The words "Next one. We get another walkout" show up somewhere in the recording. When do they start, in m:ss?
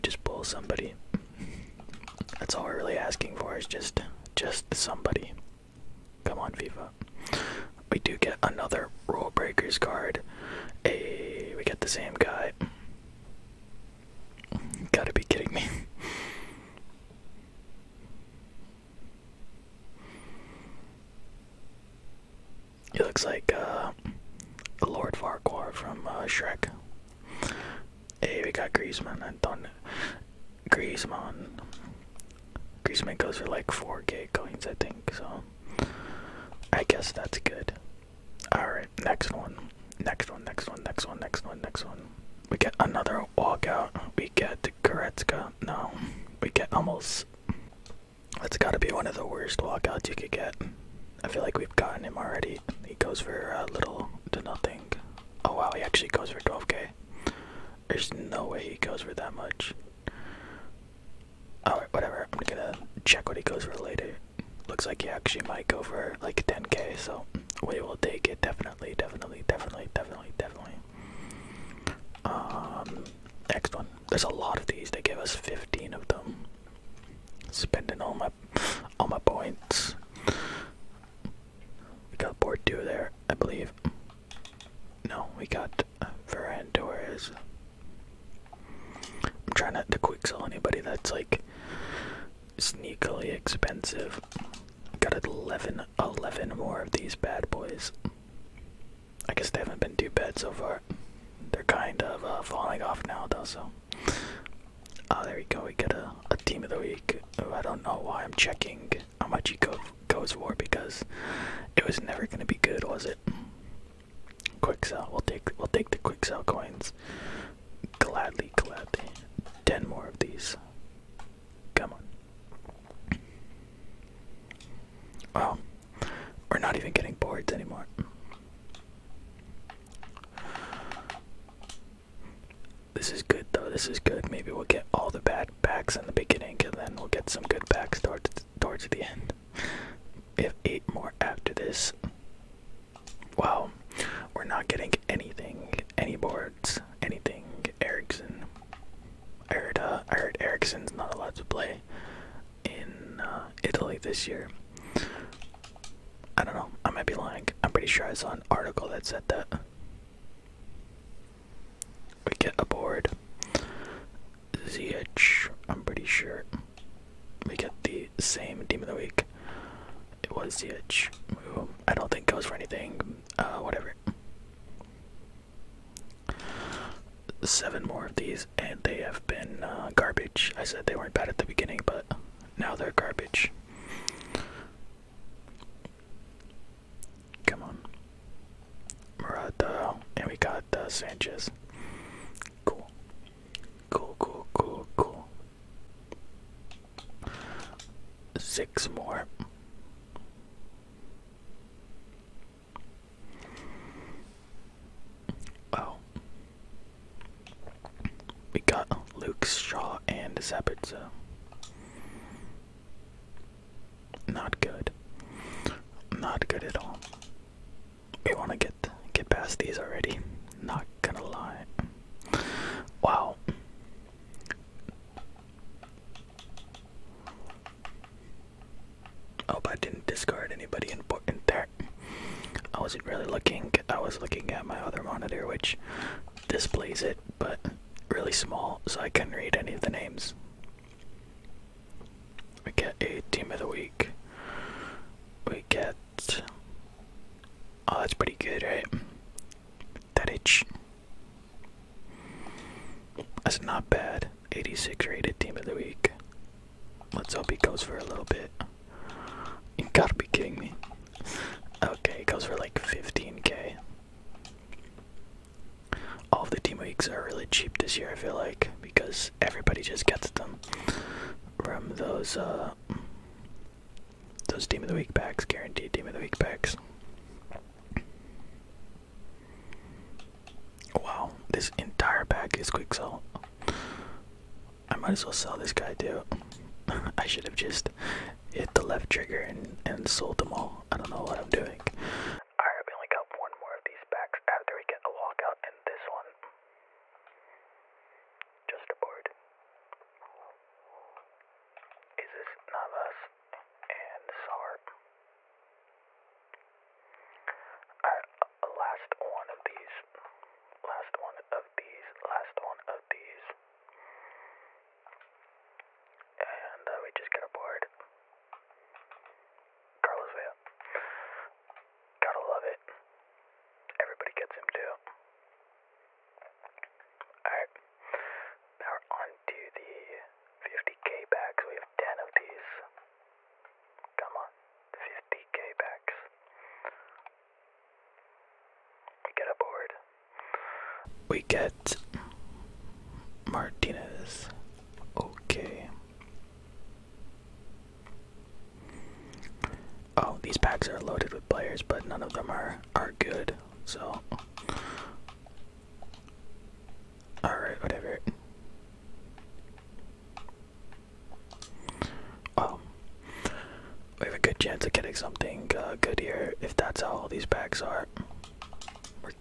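0:41.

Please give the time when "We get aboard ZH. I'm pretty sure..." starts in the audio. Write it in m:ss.
2:42.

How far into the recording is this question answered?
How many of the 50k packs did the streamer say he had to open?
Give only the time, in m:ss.
5:32.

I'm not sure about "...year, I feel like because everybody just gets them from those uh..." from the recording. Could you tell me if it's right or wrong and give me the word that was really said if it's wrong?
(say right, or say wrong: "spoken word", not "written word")
right.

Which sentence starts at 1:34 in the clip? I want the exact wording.
Got 11, 11 more of these bad boys.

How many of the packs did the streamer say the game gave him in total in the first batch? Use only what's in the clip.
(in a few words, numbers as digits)
15.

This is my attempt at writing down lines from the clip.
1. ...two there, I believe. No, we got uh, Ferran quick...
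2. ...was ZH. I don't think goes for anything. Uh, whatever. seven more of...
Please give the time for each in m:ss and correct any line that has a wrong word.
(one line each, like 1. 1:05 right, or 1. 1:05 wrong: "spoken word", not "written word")
1. 1:22 right
2. 2:50 right.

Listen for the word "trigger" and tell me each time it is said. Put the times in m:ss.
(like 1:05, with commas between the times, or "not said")
4:49.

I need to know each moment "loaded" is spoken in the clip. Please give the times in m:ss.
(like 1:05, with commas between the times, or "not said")
5:50.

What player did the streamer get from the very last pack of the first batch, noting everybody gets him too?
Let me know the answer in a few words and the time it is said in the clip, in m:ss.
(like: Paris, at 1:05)
Carlos Vela, at 5:19.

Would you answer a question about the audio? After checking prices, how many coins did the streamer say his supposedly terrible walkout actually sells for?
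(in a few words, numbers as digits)
12k.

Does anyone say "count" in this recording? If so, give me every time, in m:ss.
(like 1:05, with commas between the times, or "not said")
not said.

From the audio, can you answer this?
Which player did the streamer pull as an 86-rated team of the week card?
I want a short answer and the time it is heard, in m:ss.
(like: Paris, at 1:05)
Tadic, at 4:10.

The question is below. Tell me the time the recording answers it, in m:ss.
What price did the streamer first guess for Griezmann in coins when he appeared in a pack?
0:33.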